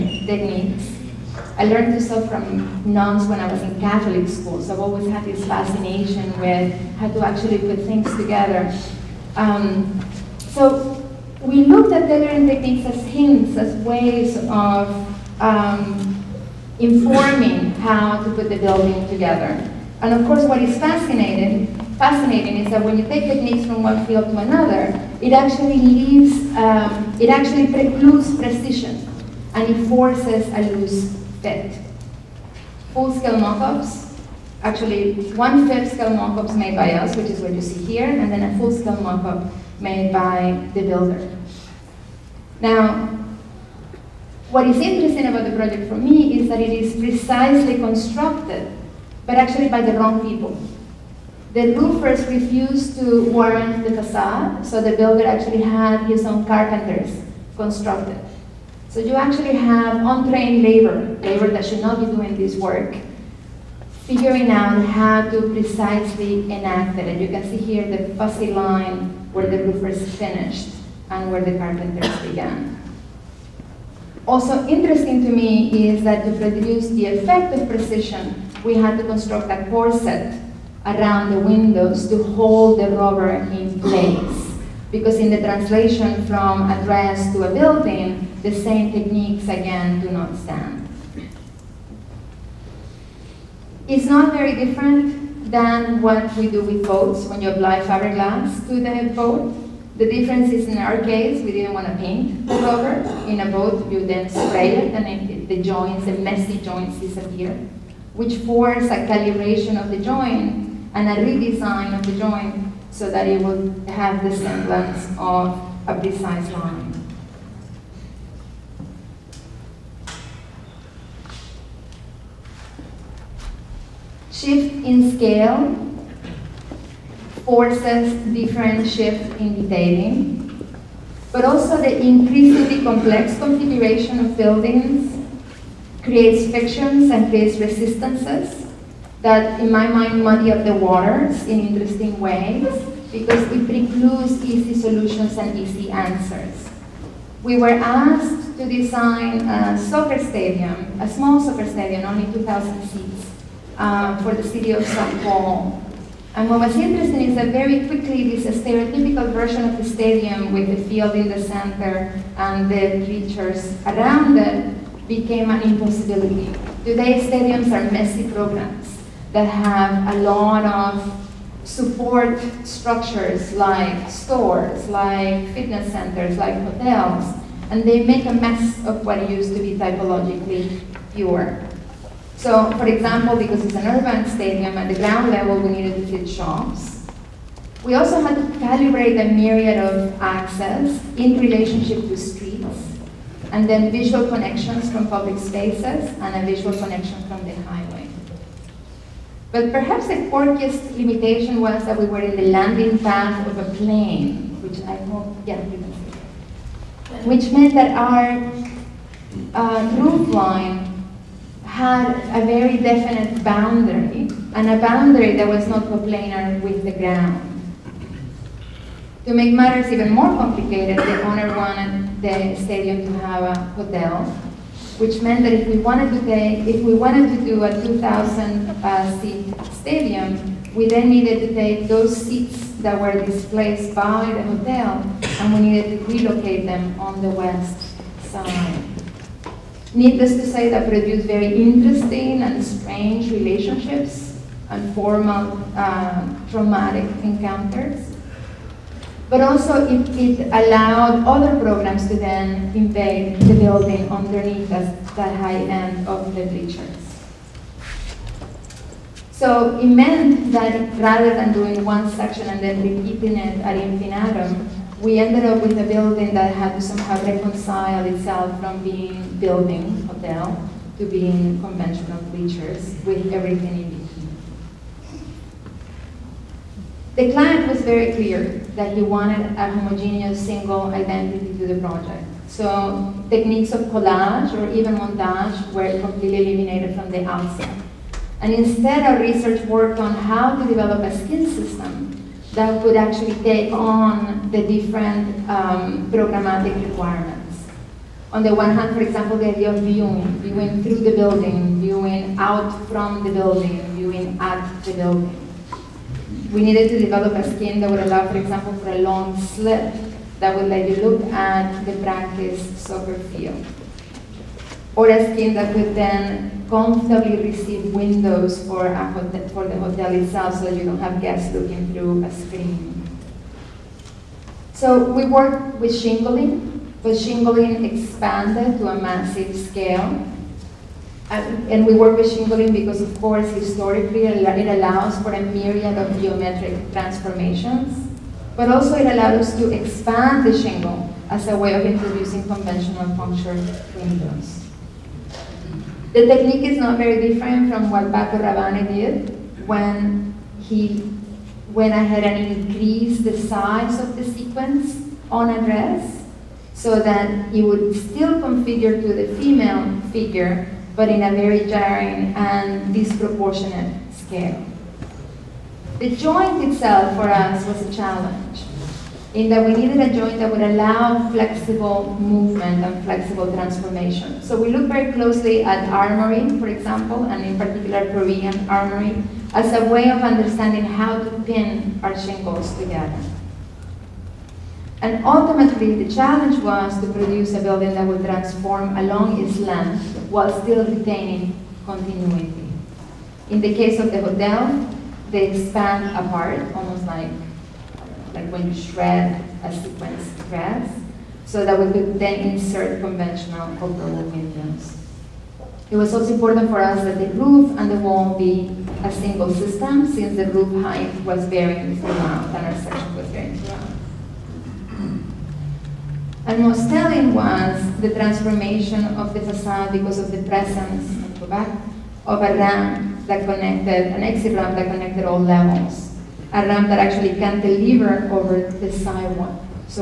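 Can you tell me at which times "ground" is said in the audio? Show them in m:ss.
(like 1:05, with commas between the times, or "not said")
3:04, 3:36.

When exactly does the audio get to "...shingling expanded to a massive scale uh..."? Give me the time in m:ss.
5:27.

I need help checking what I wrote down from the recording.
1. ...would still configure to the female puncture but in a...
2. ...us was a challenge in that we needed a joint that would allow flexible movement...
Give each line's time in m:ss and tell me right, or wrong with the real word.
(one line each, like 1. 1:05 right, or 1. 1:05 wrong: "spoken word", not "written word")
1. 5:57 wrong: "figure", not "puncture"
2. 6:07 right.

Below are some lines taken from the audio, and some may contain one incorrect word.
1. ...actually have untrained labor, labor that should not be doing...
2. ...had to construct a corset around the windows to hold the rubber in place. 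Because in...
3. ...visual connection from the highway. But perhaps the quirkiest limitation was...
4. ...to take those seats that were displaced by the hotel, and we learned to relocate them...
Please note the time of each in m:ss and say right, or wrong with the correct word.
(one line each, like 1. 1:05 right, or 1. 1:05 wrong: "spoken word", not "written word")
1. 0:59 right
2. 1:18 right
3. 3:16 right
4. 3:51 wrong: "needed", not "learned".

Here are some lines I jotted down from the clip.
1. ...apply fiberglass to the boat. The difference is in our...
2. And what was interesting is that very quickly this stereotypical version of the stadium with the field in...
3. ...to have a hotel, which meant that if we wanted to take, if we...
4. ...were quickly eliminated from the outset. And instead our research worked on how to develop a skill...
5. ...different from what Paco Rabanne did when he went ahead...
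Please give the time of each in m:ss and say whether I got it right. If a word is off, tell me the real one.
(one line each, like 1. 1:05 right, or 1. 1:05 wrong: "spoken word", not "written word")
1. 1:37 right
2. 2:36 right
3. 3:43 right
4. 4:45 wrong: "completely", not "quickly"
5. 5:47 right.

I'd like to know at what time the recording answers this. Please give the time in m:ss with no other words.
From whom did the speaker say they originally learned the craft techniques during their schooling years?
0:02.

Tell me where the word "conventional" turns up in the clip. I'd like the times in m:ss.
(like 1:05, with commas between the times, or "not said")
4:31, 5:42, 6:43.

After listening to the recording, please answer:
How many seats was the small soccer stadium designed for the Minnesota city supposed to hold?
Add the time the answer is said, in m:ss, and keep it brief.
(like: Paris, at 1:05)
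2,000, at 2:32.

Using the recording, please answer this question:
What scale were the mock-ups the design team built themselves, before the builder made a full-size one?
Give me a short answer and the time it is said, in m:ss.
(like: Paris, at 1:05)
One-fifth scale, at 0:35.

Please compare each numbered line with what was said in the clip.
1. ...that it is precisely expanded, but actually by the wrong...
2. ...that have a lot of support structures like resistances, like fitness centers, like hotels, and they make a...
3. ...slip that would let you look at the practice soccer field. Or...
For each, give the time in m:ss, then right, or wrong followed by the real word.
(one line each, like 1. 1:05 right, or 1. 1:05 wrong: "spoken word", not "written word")
1. 0:46 wrong: "constructed", not "expanded"
2. 2:49 wrong: "stores", not "resistances"
3. 5:09 right.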